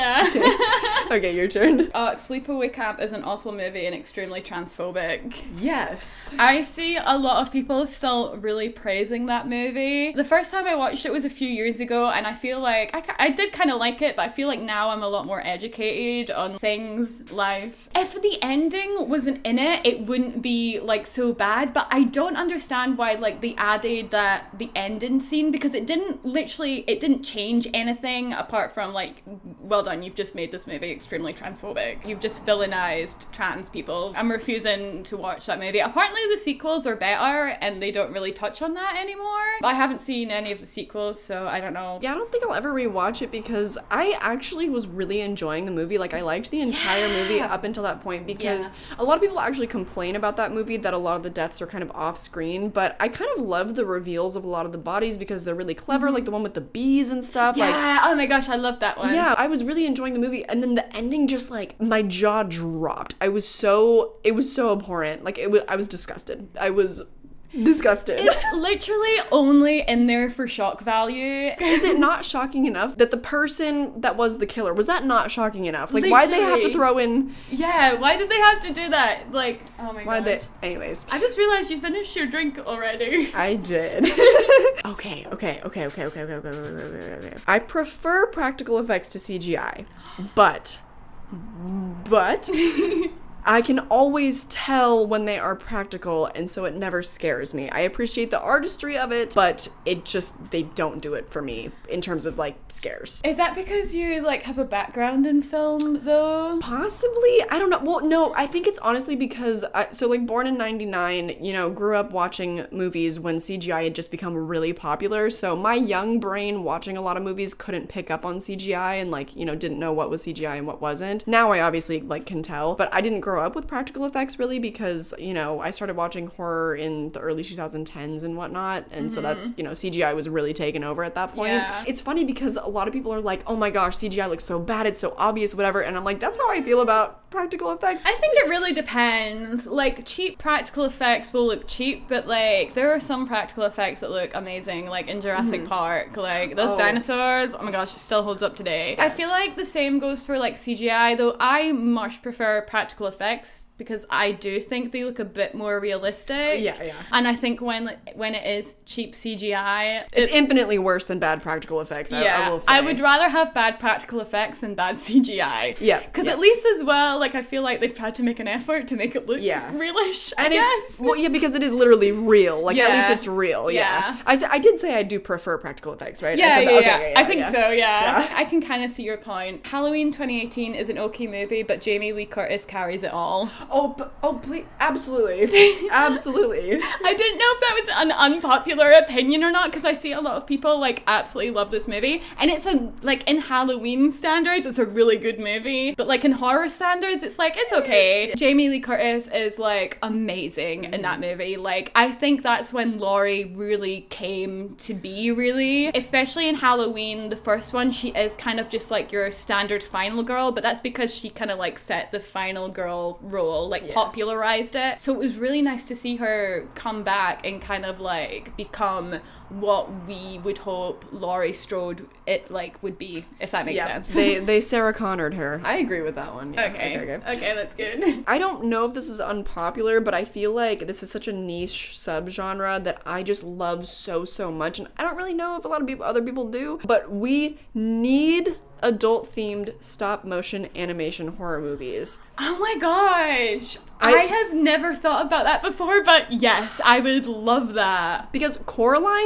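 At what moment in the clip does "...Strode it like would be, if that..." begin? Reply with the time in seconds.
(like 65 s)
221 s.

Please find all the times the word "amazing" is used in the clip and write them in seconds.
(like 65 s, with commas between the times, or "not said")
144 s, 200 s.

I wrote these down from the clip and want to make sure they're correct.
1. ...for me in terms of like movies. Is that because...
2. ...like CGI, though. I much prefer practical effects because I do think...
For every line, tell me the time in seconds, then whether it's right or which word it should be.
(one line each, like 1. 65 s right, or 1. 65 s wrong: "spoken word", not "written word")
1. 101 s wrong: "scares", not "movies"
2. 150 s right.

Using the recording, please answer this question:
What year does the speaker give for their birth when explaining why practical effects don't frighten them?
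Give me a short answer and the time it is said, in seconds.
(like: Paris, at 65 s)
1999, at 110 s.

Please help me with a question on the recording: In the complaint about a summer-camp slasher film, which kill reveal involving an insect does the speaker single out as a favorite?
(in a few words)
the bees.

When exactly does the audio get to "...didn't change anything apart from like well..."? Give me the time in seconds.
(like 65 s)
26 s.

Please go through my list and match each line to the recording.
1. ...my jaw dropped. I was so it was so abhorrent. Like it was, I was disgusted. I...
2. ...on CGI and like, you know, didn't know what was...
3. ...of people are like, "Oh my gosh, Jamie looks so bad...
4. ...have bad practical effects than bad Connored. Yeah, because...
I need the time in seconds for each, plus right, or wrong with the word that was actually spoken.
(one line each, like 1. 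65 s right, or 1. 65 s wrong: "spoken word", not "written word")
1. 61 s right
2. 118 s right
3. 132 s wrong: "CGI", not "Jamie"
4. 163 s wrong: "CGI", not "Connored".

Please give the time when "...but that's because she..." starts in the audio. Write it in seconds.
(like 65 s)
210 s.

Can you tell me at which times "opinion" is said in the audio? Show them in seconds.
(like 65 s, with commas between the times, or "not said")
188 s.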